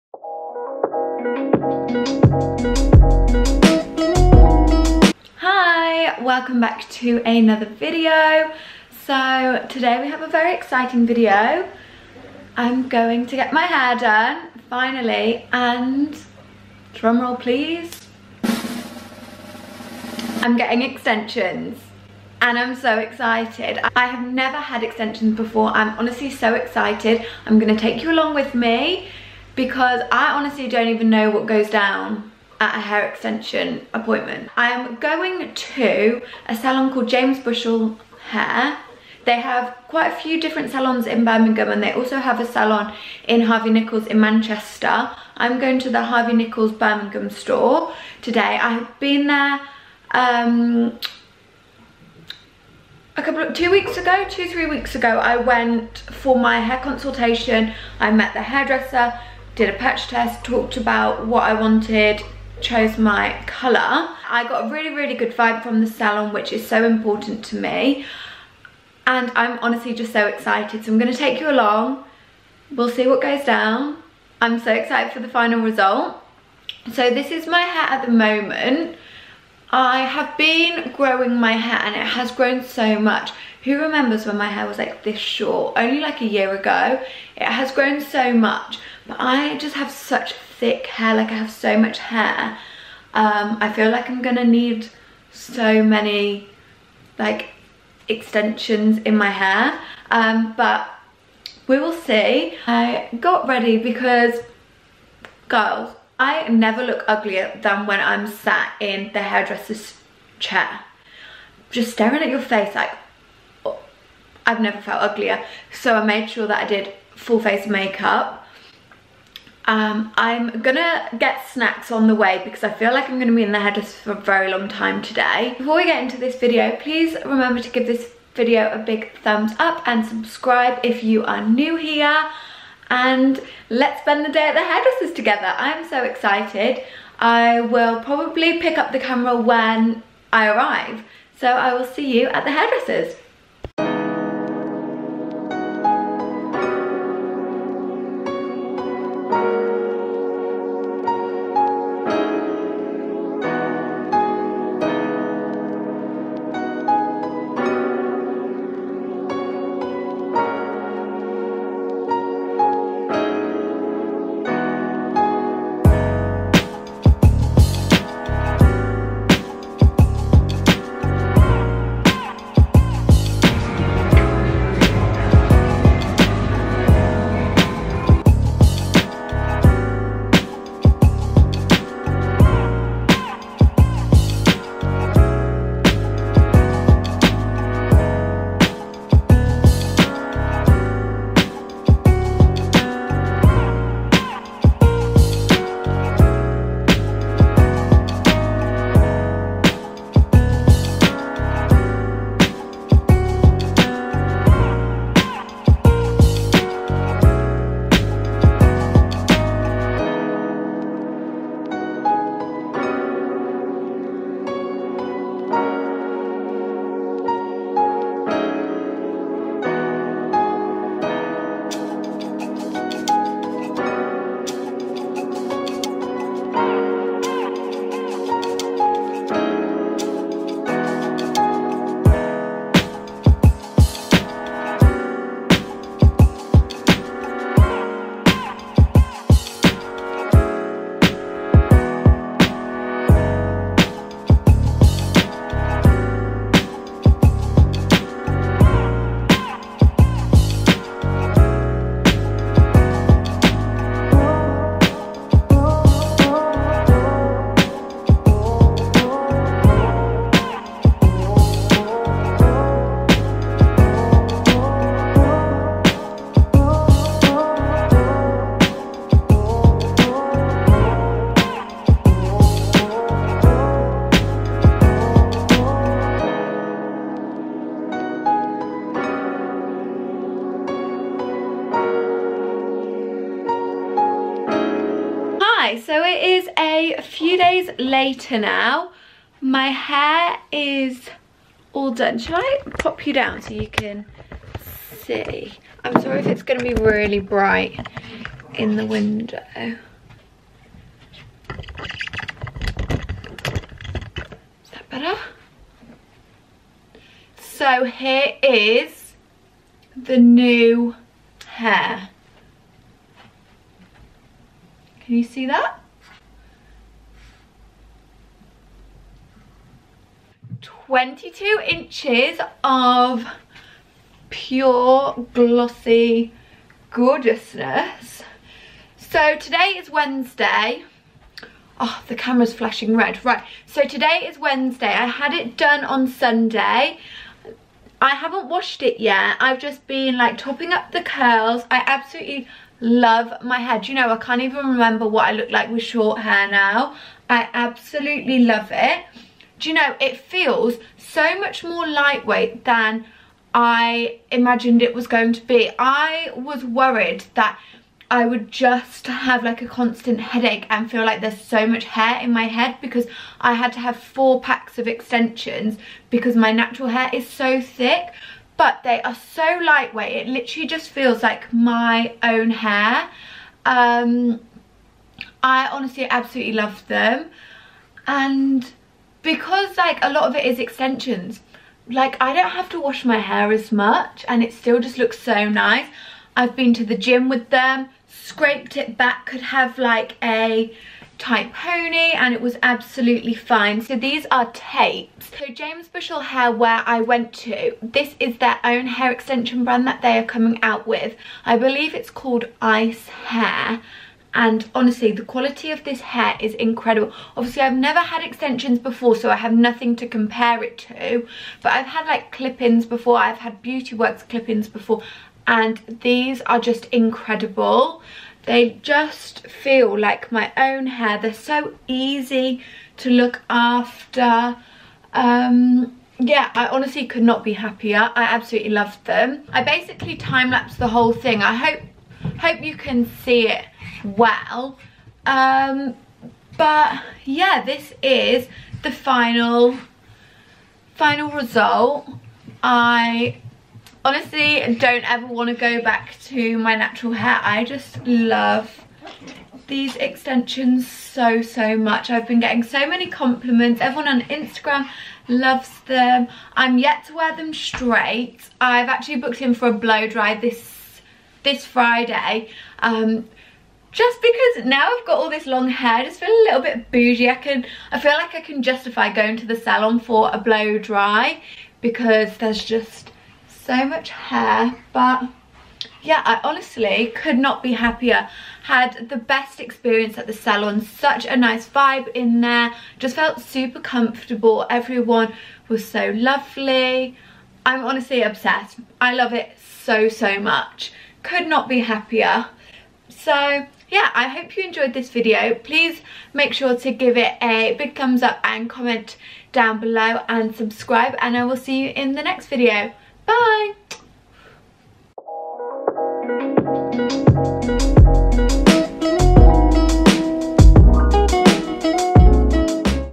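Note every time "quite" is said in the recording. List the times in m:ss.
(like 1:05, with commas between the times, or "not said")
0:39.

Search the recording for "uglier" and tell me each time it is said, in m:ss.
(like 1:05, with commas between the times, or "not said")
1:47, 1:55.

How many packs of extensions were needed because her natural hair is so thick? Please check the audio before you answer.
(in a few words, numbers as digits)
4.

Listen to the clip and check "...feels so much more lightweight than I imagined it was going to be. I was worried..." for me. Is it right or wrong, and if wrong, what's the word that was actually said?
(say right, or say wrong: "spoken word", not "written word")
right.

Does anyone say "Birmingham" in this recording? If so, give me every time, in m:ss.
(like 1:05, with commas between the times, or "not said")
0:41, 0:46.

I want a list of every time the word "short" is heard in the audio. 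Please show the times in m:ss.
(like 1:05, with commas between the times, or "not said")
1:25, 5:45.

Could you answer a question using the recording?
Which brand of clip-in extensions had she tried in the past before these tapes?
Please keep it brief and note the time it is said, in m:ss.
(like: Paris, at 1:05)
Beauty Works, at 6:53.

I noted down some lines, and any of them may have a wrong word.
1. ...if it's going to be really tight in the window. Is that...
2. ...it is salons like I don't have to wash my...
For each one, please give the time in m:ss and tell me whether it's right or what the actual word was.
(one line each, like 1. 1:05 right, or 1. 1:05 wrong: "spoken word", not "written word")
1. 4:56 wrong: "bright", not "tight"
2. 6:20 wrong: "extensions", not "salons".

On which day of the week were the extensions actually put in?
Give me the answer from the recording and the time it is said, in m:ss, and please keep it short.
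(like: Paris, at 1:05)
Sunday, at 5:36.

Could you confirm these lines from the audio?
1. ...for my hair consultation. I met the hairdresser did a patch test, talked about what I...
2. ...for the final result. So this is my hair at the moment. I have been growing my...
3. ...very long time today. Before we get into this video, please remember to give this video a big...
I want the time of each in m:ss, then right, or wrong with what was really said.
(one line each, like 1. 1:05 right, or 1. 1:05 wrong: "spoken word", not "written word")
1. 0:55 right
2. 1:15 right
3. 2:04 right.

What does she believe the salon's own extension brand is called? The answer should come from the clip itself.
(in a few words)
ice hair.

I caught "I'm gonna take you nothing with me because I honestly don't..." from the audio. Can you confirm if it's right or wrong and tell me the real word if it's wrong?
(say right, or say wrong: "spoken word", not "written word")
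wrong: "along", not "nothing".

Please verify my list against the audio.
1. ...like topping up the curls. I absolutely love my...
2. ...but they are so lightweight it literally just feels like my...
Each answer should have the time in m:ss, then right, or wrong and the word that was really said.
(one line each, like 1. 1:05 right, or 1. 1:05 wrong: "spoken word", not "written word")
1. 5:40 right
2. 6:08 right.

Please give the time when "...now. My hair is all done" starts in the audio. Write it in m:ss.
4:48.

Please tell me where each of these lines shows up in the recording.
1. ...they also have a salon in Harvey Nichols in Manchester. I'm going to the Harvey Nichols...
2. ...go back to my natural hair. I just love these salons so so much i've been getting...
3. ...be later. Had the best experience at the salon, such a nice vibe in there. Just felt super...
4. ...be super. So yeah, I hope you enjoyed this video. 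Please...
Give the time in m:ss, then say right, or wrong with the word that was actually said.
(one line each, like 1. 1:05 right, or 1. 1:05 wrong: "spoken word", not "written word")
1. 0:41 right
2. 7:25 wrong: "extensions", not "salons"
3. 7:57 wrong: "happier", not "later"
4. 8:11 wrong: "happier", not "super".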